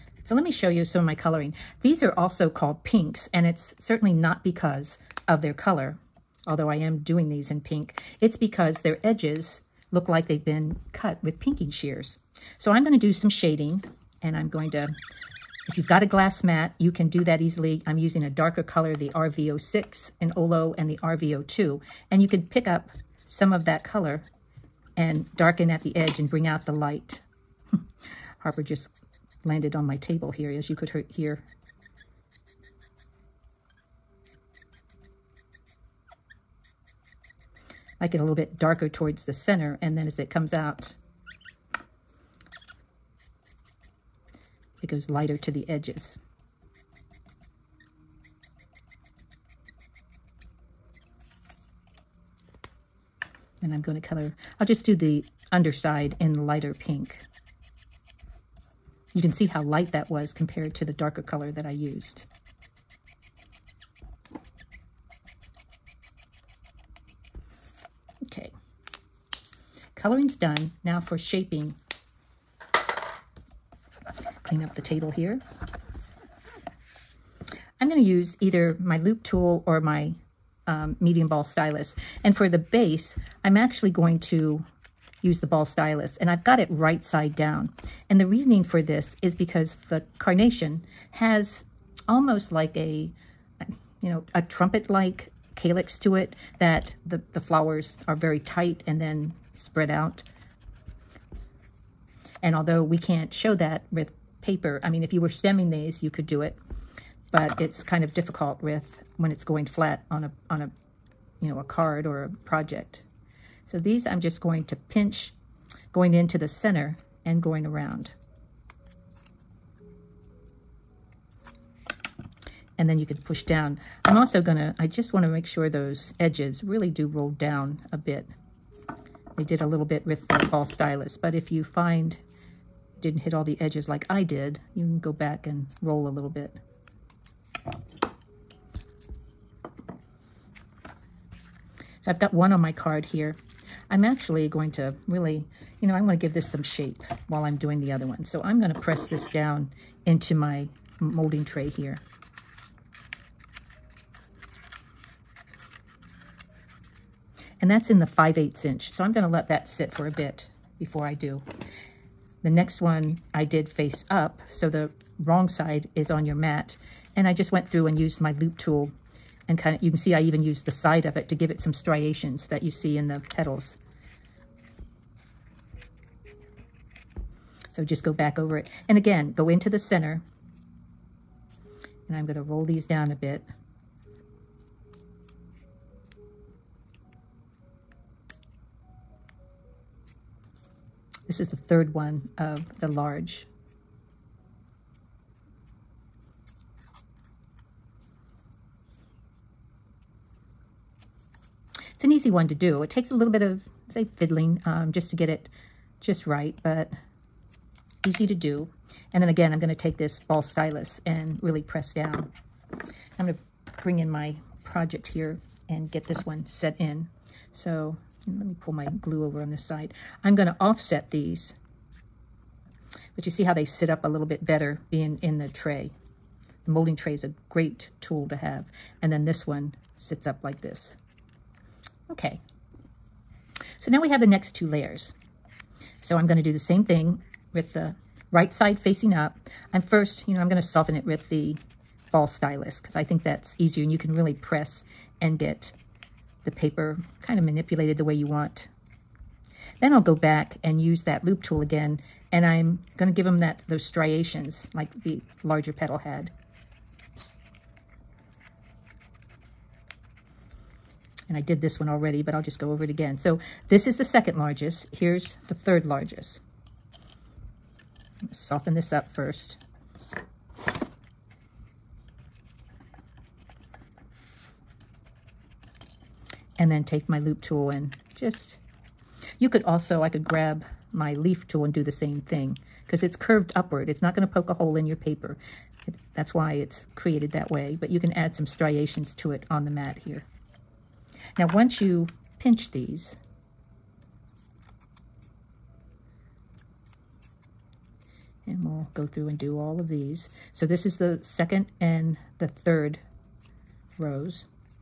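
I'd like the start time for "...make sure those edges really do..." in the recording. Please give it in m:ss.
2:05.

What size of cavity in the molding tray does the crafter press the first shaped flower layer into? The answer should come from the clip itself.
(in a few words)
5/8 inch.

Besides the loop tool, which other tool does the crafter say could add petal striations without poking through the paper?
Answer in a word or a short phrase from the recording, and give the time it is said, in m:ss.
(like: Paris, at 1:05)
Leaf tool, at 4:41.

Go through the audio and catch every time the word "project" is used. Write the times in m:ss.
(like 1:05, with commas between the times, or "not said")
1:52, 3:34.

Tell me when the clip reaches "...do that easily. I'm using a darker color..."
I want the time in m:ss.
0:17.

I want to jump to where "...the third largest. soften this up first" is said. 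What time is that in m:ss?
4:25.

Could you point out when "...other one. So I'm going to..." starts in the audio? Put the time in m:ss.
2:27.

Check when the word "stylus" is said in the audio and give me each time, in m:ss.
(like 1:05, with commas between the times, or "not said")
1:21, 1:25, 2:10, 3:30, 4:02.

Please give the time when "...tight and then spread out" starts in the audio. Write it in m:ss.
1:38.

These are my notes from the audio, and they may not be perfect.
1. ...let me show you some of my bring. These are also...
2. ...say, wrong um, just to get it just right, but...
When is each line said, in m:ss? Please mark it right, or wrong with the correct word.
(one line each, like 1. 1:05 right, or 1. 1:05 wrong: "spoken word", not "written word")
1. 0:00 wrong: "coloring", not "bring"
2. 3:23 wrong: "fiddling", not "wrong".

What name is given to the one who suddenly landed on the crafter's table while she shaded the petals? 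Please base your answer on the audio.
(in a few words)
Harper.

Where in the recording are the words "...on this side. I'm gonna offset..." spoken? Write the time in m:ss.
3:39.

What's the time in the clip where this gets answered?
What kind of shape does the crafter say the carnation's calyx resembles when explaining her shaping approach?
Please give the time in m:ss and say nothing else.
1:34.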